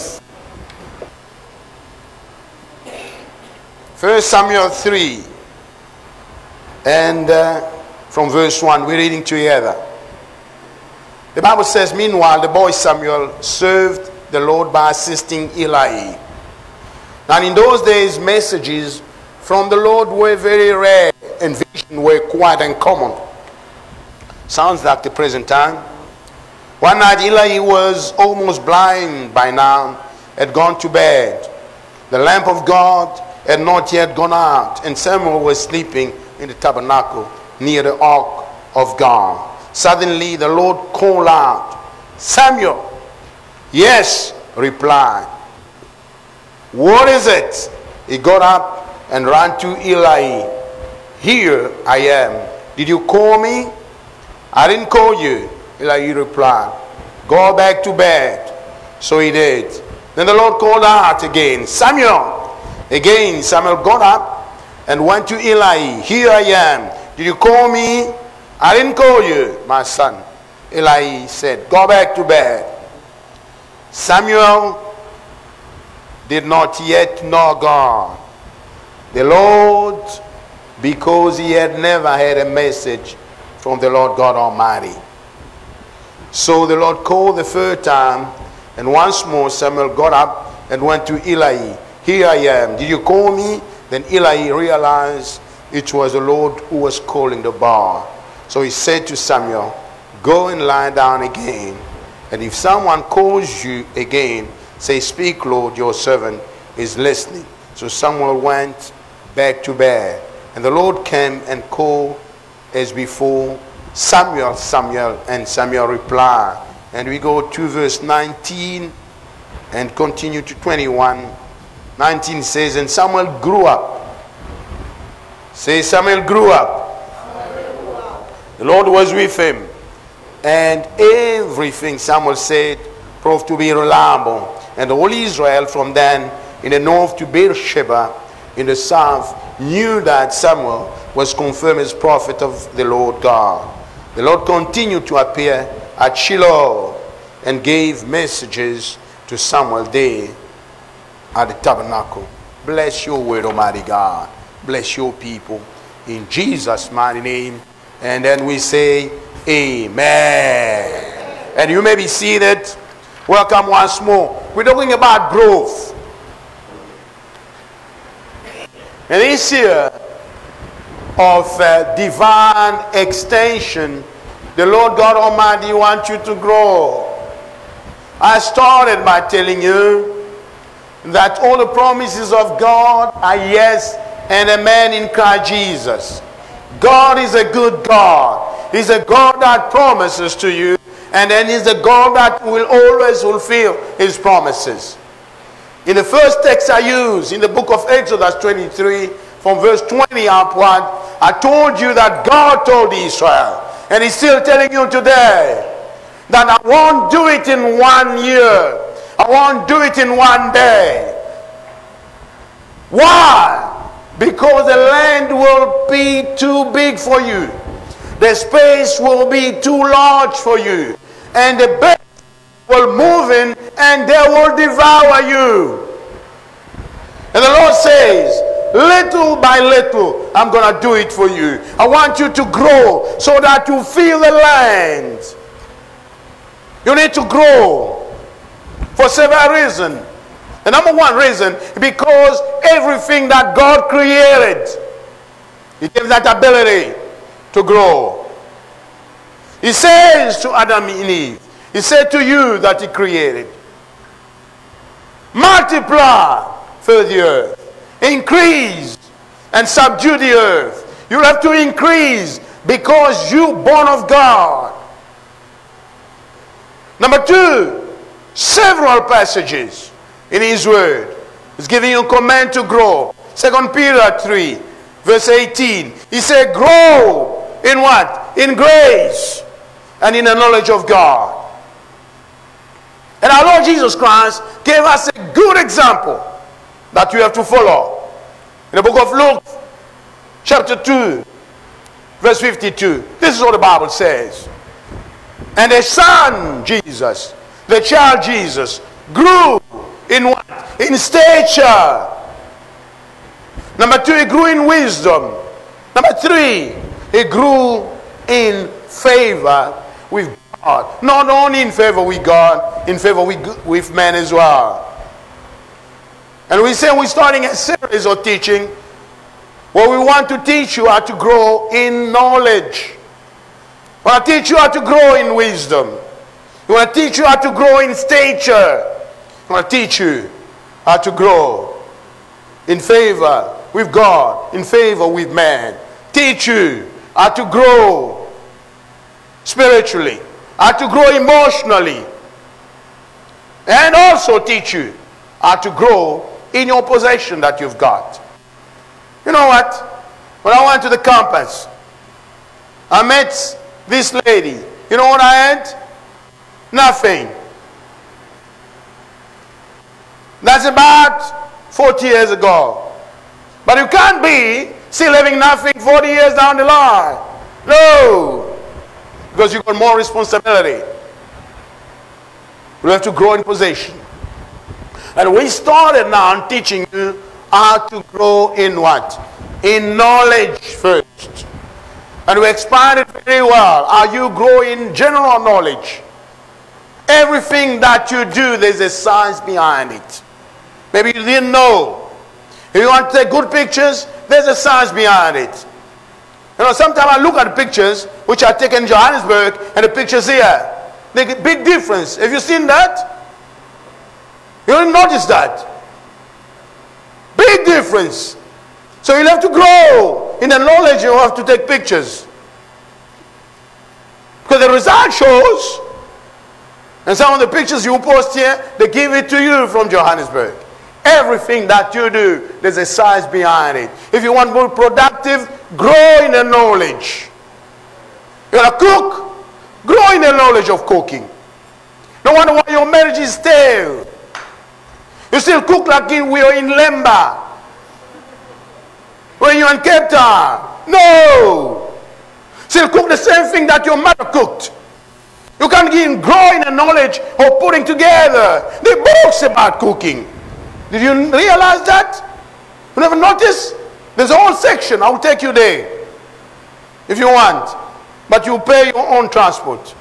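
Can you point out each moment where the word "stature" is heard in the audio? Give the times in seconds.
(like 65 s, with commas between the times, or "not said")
300 s, 327 s.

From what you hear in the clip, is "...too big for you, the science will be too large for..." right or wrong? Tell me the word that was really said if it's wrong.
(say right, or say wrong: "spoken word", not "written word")
wrong: "space", not "science".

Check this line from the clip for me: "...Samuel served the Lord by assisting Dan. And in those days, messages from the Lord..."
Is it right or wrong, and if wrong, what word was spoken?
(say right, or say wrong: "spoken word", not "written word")
wrong: "Eli", not "Dan".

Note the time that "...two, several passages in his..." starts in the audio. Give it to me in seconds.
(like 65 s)
267 s.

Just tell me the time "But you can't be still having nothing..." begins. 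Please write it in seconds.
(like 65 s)
363 s.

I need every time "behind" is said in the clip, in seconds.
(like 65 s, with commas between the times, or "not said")
389 s, 394 s, 423 s.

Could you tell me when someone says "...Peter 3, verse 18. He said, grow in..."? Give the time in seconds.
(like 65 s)
273 s.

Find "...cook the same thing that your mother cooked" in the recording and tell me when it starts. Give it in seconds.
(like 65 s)
442 s.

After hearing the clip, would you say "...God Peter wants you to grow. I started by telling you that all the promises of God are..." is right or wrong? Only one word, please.
wrong.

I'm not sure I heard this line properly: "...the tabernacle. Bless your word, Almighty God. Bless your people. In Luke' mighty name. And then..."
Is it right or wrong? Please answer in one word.
wrong.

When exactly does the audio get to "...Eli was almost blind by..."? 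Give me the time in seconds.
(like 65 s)
27 s.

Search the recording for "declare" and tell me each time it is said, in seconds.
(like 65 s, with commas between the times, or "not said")
not said.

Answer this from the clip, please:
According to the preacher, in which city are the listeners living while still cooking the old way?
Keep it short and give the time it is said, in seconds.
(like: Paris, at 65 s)
Cape Town, at 439 s.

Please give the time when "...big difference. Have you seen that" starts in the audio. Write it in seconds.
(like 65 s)
401 s.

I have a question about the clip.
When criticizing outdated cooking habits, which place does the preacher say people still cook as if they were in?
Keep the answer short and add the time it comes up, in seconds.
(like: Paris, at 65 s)
Lemba, at 436 s.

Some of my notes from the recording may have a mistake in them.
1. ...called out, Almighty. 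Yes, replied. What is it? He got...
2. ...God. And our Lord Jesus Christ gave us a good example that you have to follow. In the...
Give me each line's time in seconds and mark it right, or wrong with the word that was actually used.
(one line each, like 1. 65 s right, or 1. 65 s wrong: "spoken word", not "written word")
1. 40 s wrong: "Samuel", not "Almighty"
2. 280 s right.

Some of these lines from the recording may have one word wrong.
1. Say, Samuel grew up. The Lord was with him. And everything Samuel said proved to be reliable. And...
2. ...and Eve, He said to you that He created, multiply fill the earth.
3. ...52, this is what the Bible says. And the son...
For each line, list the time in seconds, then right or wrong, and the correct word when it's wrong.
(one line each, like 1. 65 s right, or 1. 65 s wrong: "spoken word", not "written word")
1. 125 s right
2. 250 s right
3. 292 s right.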